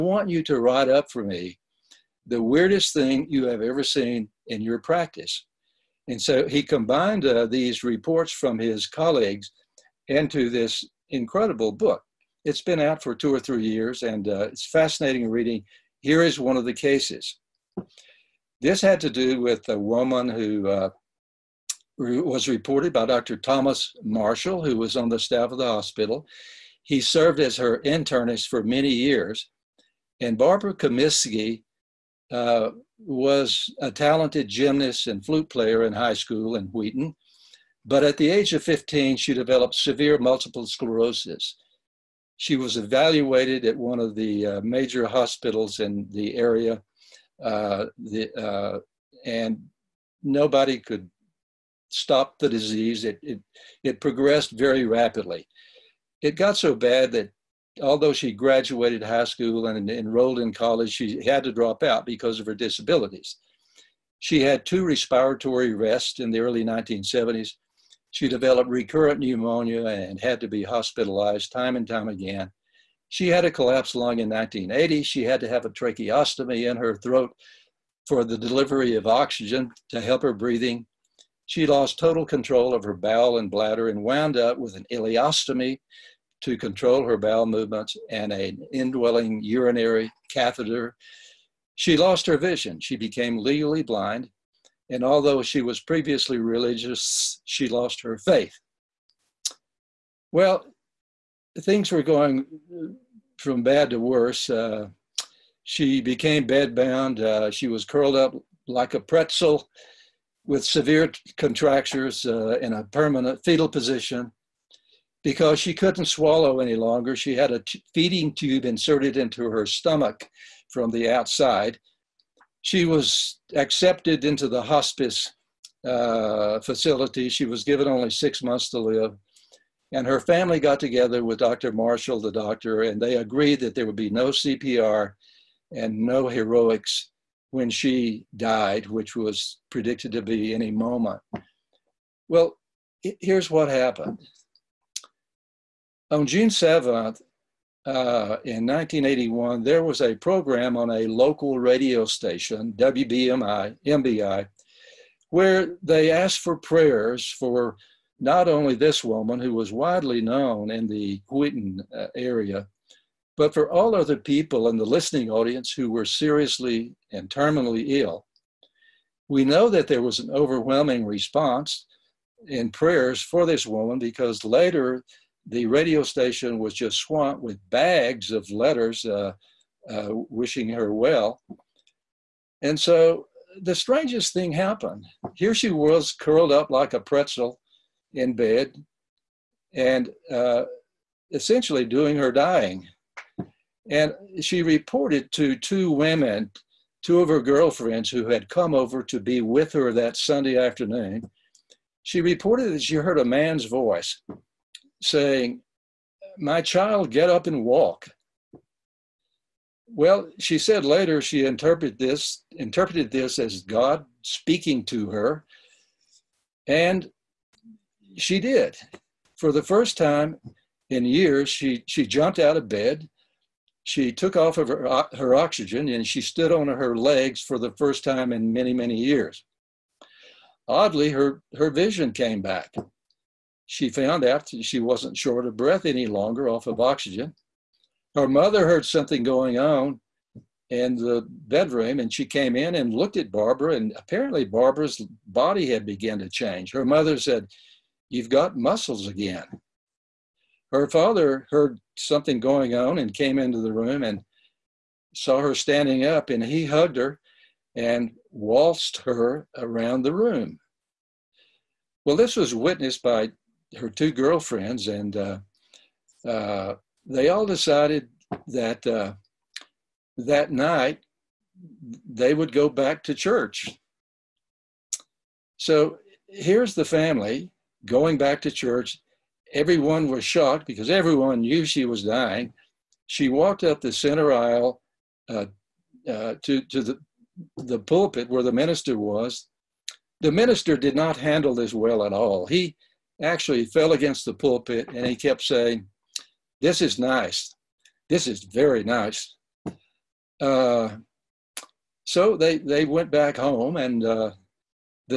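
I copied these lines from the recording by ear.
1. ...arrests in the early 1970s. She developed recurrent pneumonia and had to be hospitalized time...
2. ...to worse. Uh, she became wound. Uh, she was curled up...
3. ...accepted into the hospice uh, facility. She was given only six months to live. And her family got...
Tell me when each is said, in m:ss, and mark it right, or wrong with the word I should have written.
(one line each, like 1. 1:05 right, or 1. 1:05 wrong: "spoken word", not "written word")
1. 1:05 right
2. 1:43 wrong: "bedbound", not "wound"
3. 2:03 right.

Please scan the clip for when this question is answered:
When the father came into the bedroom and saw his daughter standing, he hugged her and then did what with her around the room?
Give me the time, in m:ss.
4:18.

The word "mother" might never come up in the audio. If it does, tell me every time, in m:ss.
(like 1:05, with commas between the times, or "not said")
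3:58, 4:06.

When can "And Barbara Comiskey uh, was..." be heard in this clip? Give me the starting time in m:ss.
0:30.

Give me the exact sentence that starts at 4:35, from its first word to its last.
So here's the family going back to church.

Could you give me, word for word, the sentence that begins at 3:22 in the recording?
She reported that she heard a man's voice saying, My child, get up and walk.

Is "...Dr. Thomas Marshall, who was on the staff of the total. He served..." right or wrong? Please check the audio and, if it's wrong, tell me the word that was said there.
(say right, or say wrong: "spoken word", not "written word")
wrong: "hospital", not "total".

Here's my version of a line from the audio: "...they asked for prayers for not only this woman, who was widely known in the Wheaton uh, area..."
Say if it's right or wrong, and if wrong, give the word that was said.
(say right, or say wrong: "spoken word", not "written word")
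right.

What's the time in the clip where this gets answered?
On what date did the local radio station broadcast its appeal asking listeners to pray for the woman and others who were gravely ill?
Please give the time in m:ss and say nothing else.
2:26.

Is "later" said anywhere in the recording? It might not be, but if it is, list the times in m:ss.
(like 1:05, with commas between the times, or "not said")
2:54, 3:30.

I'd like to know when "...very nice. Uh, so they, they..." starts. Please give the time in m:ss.
4:58.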